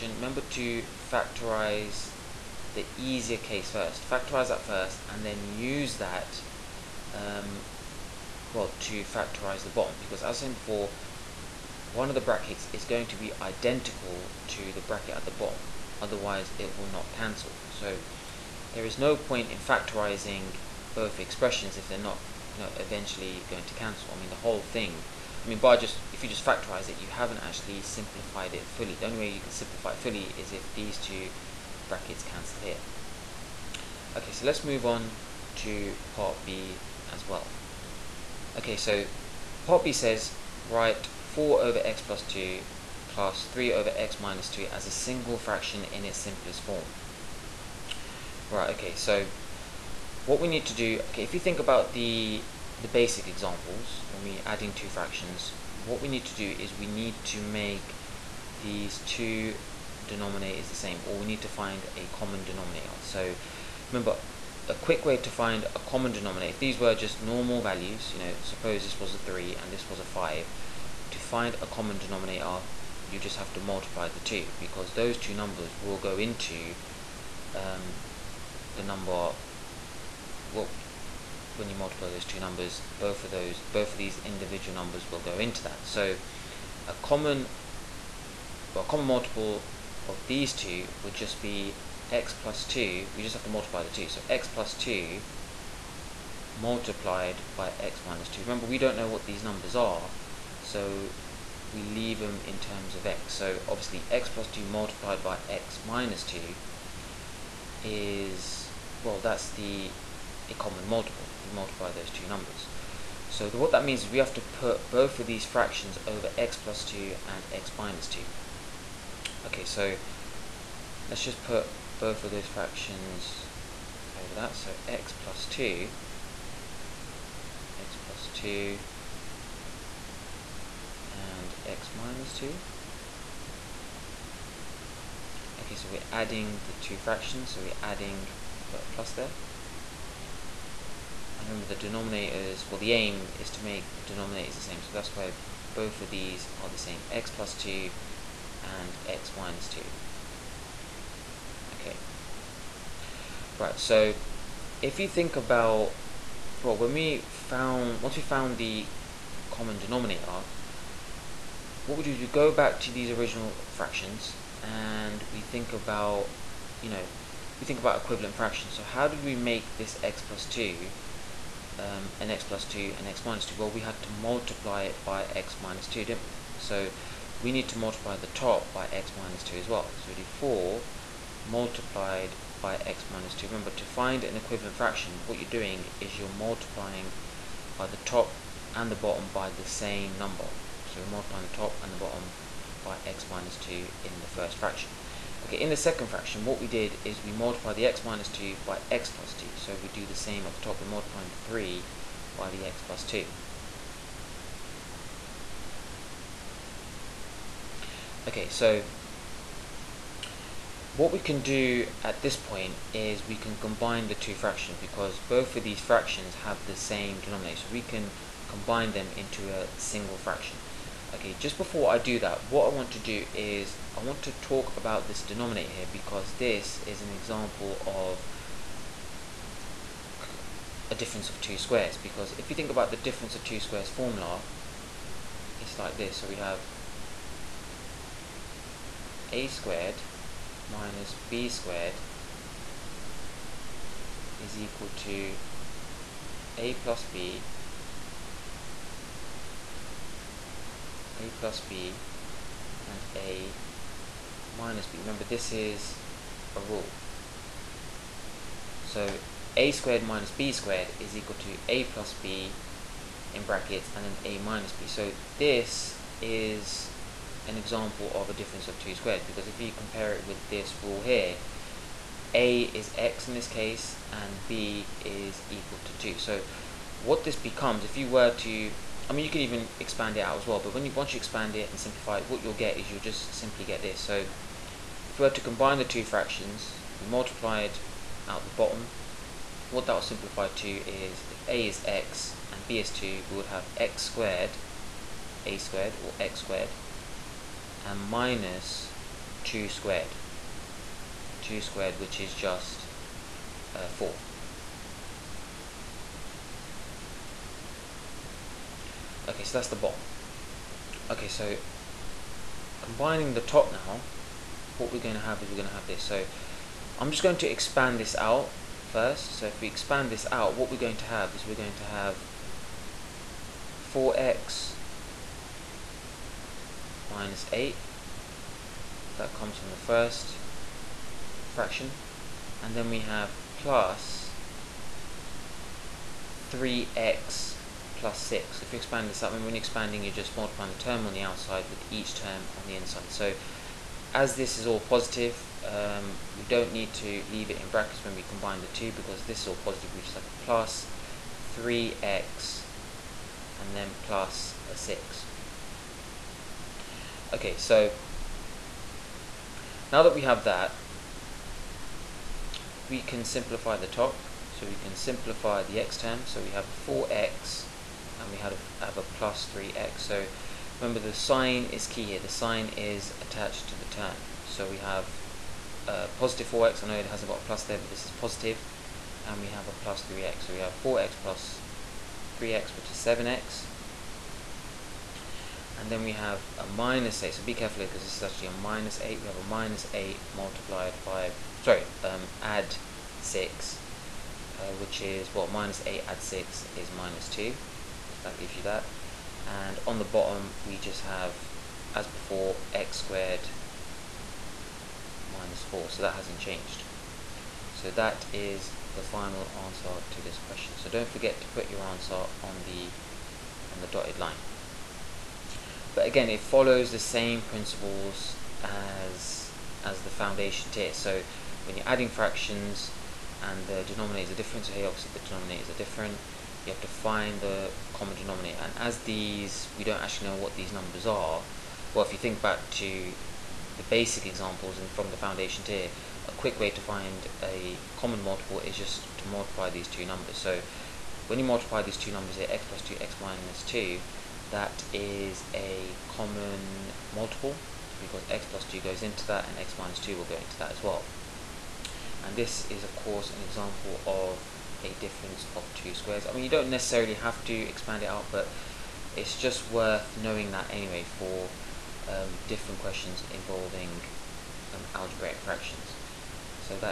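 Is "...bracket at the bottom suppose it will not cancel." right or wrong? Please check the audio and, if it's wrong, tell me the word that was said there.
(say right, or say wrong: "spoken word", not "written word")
wrong: "otherwise", not "suppose".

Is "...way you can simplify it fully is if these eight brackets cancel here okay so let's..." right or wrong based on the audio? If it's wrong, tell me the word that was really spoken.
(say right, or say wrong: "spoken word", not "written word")
wrong: "two", not "eight".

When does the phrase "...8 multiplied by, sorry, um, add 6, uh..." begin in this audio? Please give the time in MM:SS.
06:29.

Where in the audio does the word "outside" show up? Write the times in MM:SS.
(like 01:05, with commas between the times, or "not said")
05:41.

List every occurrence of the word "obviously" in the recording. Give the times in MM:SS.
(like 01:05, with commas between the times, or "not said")
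01:43, 07:04.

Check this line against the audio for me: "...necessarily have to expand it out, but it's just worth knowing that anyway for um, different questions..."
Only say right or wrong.
right.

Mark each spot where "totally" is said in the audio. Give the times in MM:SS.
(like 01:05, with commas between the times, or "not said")
not said.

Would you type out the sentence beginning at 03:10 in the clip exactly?
So we're multiplying the top and the bottom by x minus 2 in the first fraction.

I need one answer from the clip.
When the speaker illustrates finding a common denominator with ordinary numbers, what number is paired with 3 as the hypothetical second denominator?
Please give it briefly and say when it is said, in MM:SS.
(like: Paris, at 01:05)
5, at 01:09.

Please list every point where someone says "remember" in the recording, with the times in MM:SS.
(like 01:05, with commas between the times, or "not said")
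00:00, 01:03, 01:38, 02:21, 03:03, 04:14, 06:10.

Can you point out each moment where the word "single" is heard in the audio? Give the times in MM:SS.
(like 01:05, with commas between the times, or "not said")
00:44, 03:39.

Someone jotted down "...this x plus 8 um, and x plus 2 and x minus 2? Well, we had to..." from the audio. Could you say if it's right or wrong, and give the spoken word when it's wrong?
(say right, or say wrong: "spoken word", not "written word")
wrong: "2", not "8".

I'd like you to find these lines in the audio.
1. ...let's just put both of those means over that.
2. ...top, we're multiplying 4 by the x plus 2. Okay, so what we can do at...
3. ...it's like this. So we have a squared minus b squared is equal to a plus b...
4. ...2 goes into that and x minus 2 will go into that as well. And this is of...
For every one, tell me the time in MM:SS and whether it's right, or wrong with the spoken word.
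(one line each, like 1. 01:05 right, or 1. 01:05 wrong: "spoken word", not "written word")
1. 02:01 wrong: "fractions", not "means"
2. 03:20 wrong: "3", not "4"
3. 03:55 right
4. 07:28 right.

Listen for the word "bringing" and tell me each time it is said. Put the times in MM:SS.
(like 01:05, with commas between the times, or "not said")
not said.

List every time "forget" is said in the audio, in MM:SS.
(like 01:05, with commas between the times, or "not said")
06:51.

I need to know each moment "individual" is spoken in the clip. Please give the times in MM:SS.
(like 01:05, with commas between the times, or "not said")
01:24.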